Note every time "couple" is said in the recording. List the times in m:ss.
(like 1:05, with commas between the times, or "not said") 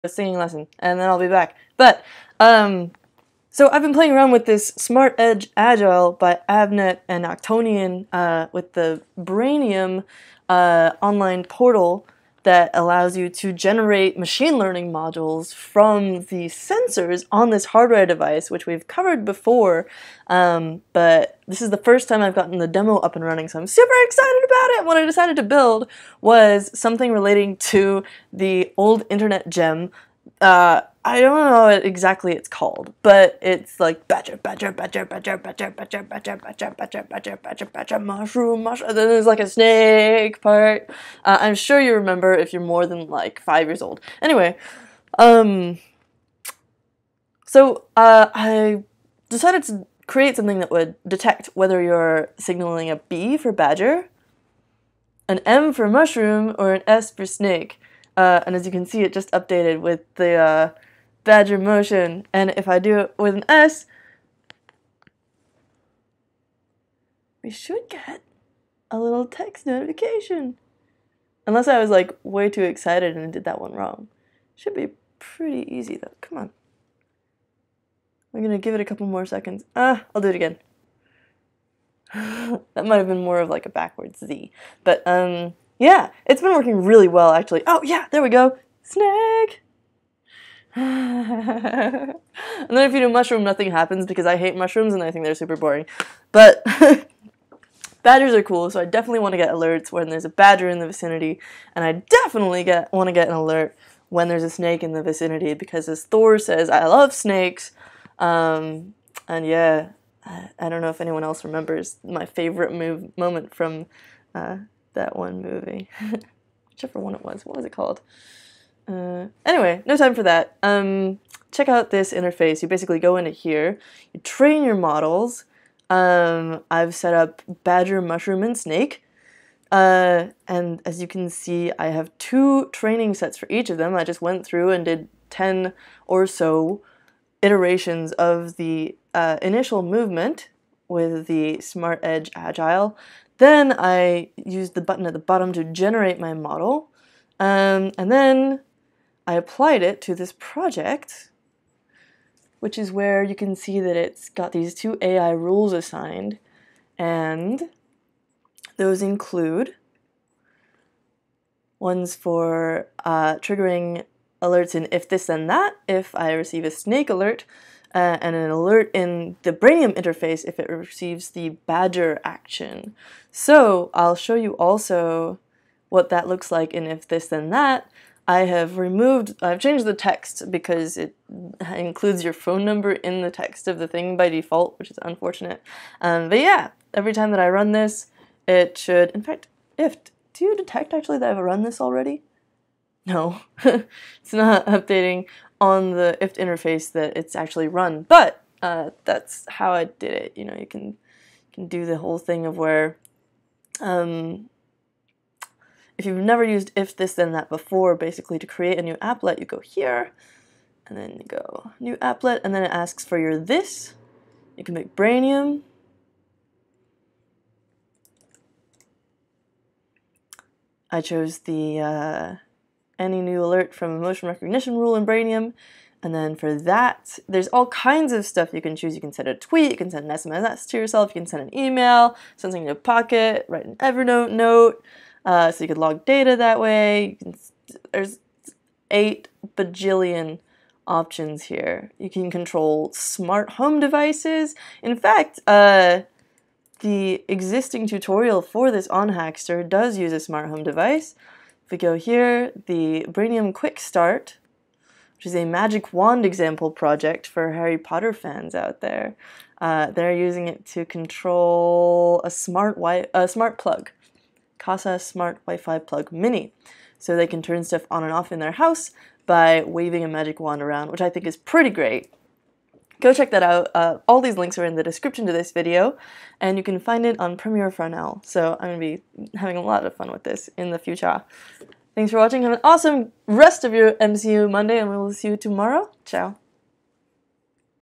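1:18.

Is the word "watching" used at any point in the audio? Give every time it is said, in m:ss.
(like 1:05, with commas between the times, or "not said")
4:42.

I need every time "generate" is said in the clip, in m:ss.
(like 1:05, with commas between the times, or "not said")
0:13, 2:25.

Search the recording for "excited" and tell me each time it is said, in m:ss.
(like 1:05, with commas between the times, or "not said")
0:24, 1:12.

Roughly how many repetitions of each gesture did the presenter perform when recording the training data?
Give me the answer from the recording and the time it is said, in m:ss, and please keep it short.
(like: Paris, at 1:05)
10, at 2:15.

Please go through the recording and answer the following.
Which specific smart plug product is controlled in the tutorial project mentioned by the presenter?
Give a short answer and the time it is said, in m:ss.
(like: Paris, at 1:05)
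Kasa Smart Wi-Fi Plug Mini, at 4:24.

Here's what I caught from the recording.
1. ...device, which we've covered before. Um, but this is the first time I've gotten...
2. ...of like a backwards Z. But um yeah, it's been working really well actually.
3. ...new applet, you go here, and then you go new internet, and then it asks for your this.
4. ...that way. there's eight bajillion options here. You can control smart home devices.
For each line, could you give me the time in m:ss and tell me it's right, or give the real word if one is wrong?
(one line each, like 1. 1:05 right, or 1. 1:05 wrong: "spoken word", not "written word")
1. 0:18 right
2. 1:23 right
3. 3:28 wrong: "applet", not "internet"
4. 3:56 right.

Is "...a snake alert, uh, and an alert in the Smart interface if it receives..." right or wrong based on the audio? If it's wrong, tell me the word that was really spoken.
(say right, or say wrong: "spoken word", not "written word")
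wrong: "Brainium", not "Smart".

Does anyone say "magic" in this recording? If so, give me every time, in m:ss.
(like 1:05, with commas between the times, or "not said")
4:15, 4:30.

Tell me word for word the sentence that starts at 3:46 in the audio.
And then for that, there's all kinds of stuff you can choose.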